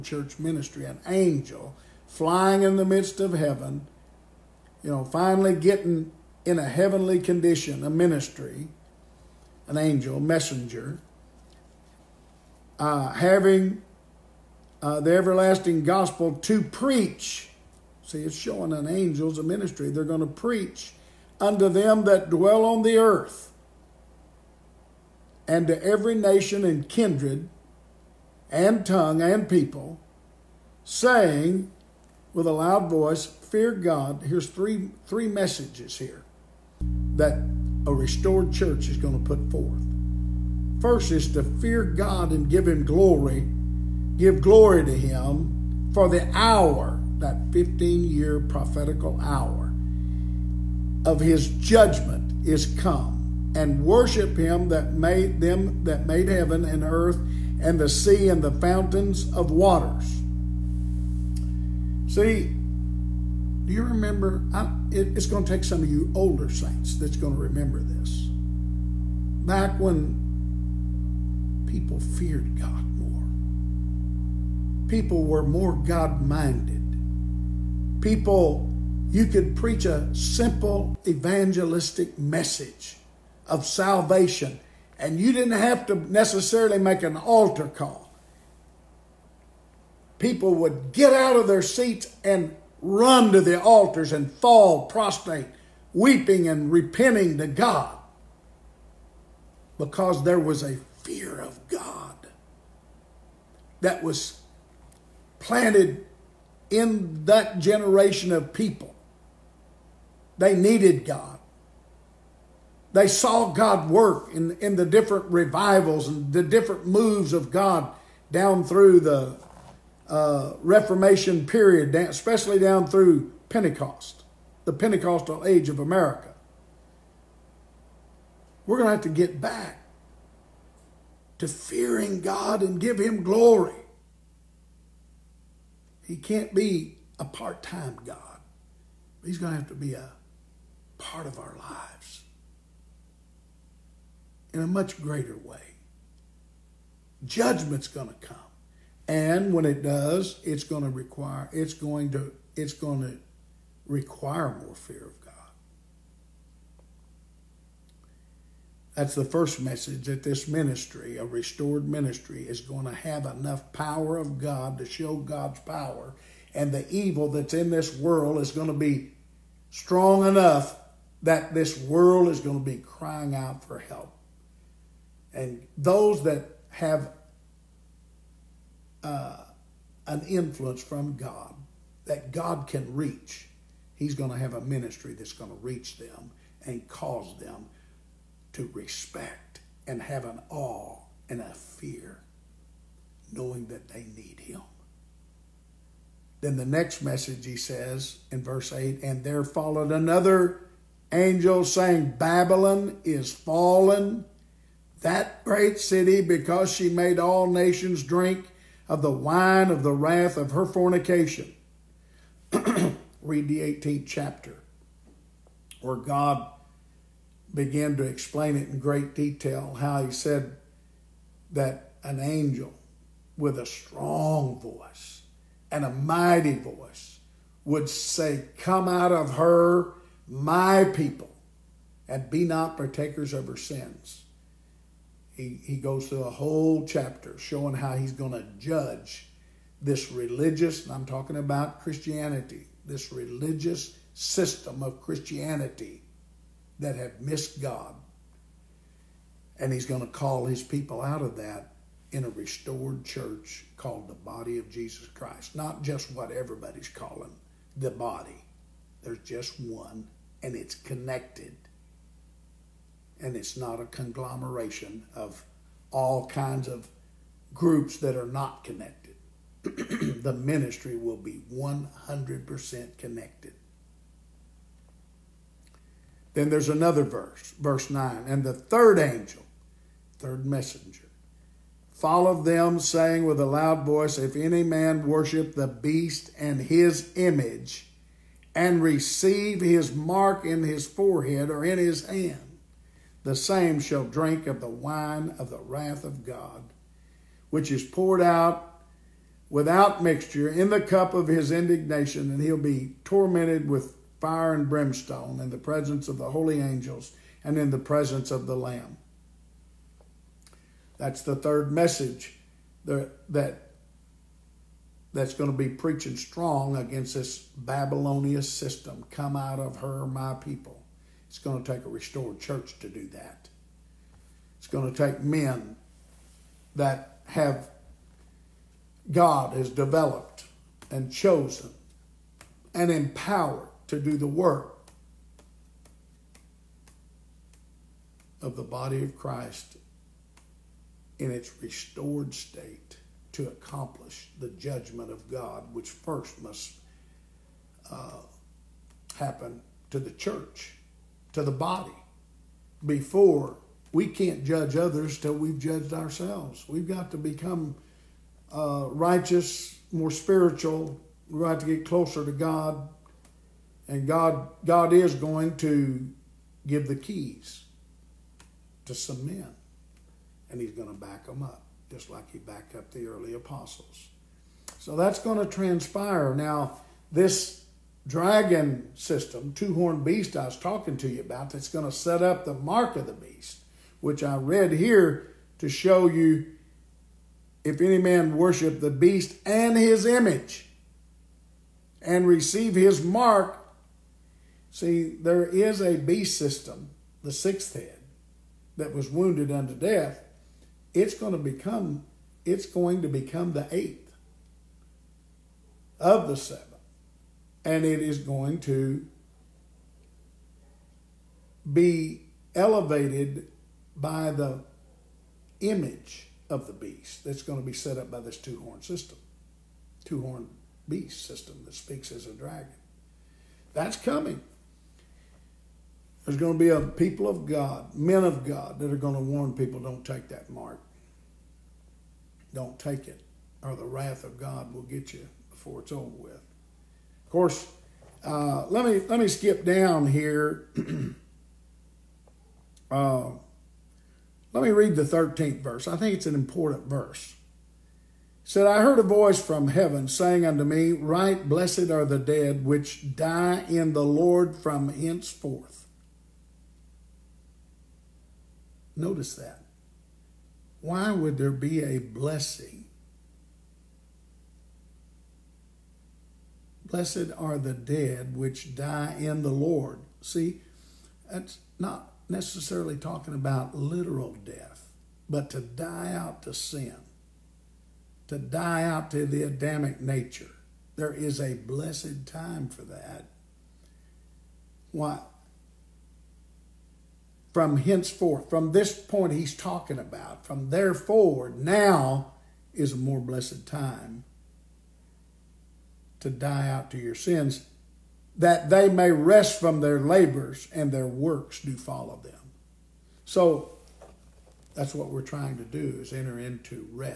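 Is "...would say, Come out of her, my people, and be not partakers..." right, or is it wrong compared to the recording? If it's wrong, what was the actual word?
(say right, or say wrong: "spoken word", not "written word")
right.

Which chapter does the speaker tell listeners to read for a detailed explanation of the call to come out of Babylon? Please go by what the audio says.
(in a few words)
18th chapter.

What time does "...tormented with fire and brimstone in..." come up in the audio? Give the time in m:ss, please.
5:03.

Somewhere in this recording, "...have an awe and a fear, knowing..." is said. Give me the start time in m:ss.
3:10.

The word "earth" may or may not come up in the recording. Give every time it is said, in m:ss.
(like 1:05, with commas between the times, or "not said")
0:22, 0:56.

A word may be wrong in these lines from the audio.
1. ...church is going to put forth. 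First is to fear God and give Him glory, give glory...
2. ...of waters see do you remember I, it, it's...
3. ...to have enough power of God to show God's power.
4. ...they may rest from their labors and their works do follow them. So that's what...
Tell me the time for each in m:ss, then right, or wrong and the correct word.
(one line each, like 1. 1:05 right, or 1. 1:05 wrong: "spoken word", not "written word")
1. 0:38 right
2. 0:59 right
3. 2:42 right
4. 8:18 right.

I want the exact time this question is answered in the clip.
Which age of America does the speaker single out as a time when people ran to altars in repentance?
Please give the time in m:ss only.
2:04.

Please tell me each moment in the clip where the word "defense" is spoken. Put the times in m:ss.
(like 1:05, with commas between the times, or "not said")
not said.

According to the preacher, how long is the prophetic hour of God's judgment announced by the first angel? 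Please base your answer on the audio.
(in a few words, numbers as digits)
15 year.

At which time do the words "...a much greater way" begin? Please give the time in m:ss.
2:24.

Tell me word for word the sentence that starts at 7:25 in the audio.
I think it's an important verse.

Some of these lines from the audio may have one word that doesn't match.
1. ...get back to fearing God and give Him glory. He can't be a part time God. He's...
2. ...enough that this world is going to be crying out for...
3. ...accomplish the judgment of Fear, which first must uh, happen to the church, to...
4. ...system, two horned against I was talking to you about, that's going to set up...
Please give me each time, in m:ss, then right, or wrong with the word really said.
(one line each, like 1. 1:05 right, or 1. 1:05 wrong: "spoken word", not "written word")
1. 2:09 right
2. 2:50 right
3. 5:43 wrong: "God", not "Fear"
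4. 6:18 wrong: "beast", not "against".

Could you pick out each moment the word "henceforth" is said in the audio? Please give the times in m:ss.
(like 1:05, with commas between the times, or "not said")
7:34, 8:07.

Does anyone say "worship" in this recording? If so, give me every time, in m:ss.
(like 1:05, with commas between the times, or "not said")
0:53, 4:45, 6:28.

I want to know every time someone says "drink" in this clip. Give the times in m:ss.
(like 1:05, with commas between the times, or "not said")
3:28, 4:54.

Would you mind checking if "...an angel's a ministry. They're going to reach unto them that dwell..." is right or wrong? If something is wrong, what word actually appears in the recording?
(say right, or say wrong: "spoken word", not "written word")
wrong: "preach", not "reach".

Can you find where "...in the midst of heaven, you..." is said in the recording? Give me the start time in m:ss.
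0:02.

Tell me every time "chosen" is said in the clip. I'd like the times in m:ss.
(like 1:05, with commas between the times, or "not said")
5:31.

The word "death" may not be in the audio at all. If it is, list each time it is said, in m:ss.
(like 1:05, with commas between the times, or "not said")
6:39, 7:54.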